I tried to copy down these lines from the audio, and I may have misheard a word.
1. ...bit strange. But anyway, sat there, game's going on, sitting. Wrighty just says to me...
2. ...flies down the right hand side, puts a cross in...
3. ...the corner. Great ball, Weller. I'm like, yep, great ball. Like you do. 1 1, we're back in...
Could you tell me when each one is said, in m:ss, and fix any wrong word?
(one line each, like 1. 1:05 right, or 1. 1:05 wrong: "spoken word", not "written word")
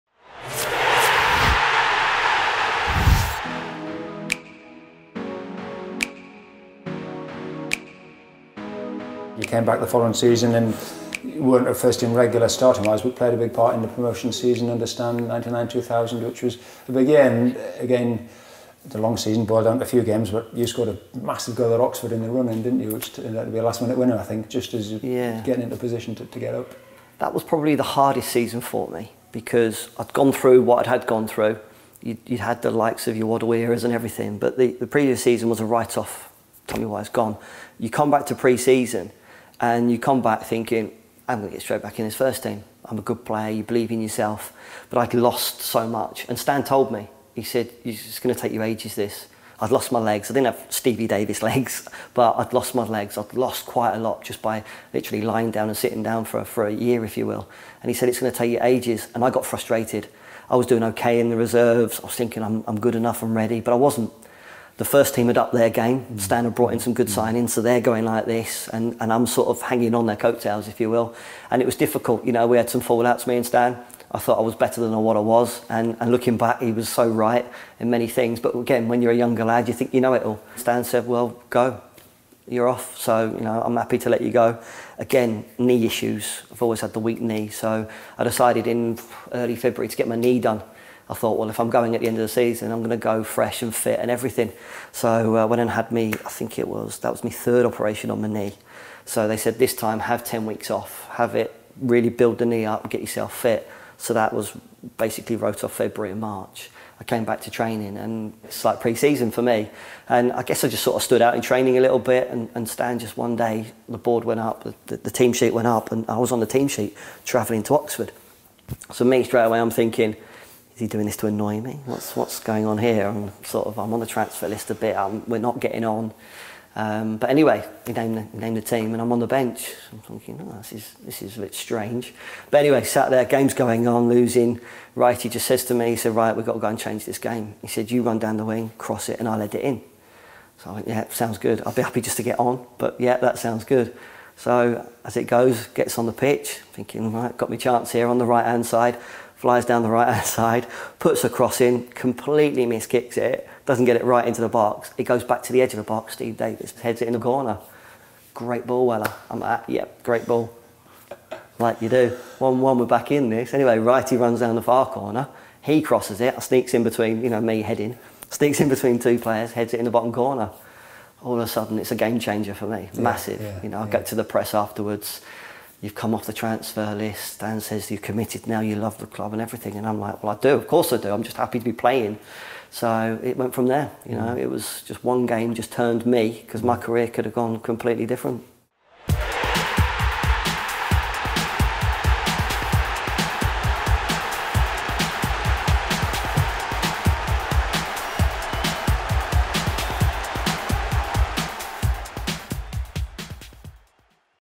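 1. 2:11 wrong: "losing", not "sitting"
2. 2:29 right
3. 2:37 right.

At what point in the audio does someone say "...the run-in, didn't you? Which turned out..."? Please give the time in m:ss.
0:22.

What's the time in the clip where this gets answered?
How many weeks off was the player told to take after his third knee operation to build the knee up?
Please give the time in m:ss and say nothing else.
1:40.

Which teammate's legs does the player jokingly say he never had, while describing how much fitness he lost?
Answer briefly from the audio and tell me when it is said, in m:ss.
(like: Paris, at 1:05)
Stevie Davis, at 0:50.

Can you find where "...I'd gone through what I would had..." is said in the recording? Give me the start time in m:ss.
0:29.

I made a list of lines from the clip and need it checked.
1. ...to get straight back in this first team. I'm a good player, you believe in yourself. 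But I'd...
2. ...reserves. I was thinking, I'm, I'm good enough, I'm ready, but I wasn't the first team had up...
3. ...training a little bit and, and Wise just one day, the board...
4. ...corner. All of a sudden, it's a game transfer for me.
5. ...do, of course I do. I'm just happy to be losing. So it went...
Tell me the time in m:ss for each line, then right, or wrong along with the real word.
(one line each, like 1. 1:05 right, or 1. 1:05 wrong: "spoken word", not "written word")
1. 0:41 right
2. 1:01 right
3. 1:51 wrong: "Stan", not "Wise"
4. 2:50 wrong: "changer", not "transfer"
5. 3:00 wrong: "playing", not "losing".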